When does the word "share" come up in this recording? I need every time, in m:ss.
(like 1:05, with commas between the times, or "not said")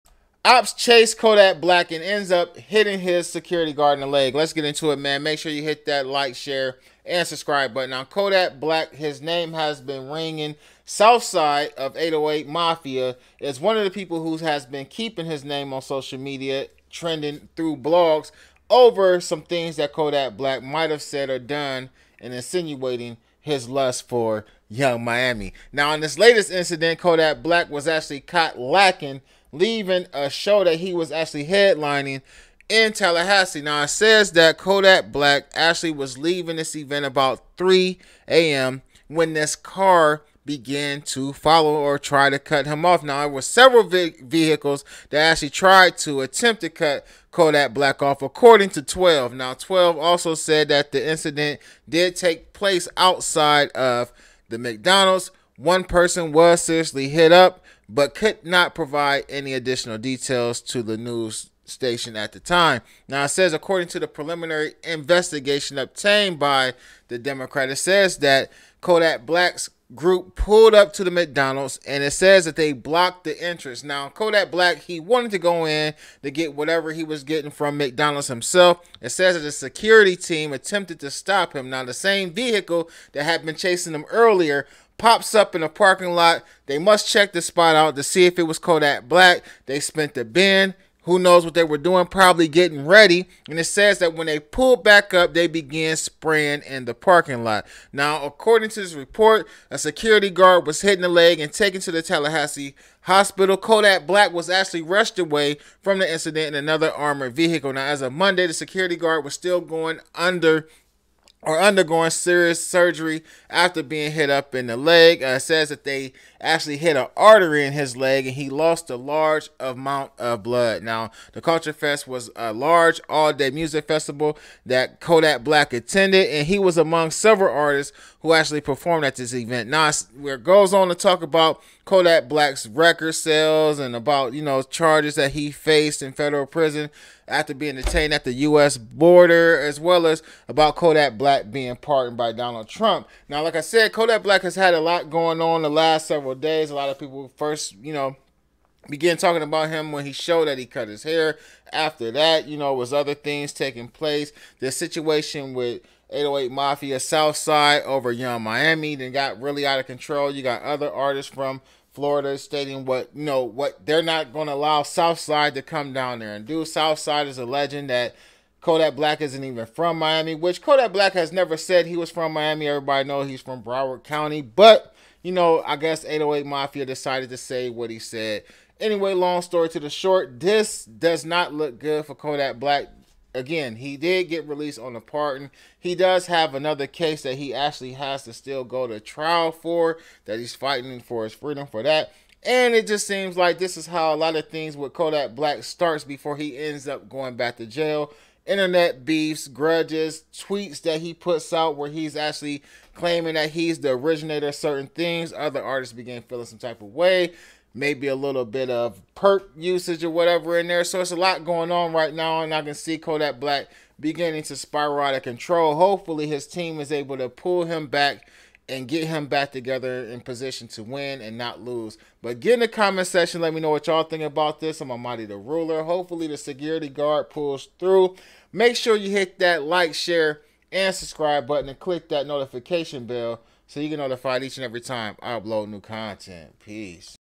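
0:06, 3:49.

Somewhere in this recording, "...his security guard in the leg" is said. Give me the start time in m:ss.
0:02.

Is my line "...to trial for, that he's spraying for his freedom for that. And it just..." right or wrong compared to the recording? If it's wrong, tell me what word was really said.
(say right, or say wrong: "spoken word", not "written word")
wrong: "fighting", not "spraying".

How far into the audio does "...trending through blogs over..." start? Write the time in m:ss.
0:16.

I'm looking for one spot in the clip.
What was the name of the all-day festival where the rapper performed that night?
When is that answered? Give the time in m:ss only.
2:01.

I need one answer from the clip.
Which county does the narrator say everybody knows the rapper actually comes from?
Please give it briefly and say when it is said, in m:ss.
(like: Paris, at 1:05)
Broward County, at 2:53.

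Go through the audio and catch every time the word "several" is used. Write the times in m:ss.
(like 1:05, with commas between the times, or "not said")
0:43, 2:07, 2:26.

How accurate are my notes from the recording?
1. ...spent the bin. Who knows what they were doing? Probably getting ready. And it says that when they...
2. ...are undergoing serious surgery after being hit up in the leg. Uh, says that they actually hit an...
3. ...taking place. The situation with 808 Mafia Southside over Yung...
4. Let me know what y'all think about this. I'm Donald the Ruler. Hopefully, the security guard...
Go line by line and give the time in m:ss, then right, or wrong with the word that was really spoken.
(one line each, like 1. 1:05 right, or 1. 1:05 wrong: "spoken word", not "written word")
1. 1:29 right
2. 1:51 right
3. 2:33 right
4. 3:43 wrong: "Amadi", not "Donald".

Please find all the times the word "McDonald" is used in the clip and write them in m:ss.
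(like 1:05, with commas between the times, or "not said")
0:54, 1:11, 1:17.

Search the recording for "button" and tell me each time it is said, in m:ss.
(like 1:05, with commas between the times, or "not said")
0:07, 3:51.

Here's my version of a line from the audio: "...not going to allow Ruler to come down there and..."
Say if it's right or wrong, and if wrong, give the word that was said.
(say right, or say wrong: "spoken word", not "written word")
wrong: "Southside", not "Ruler".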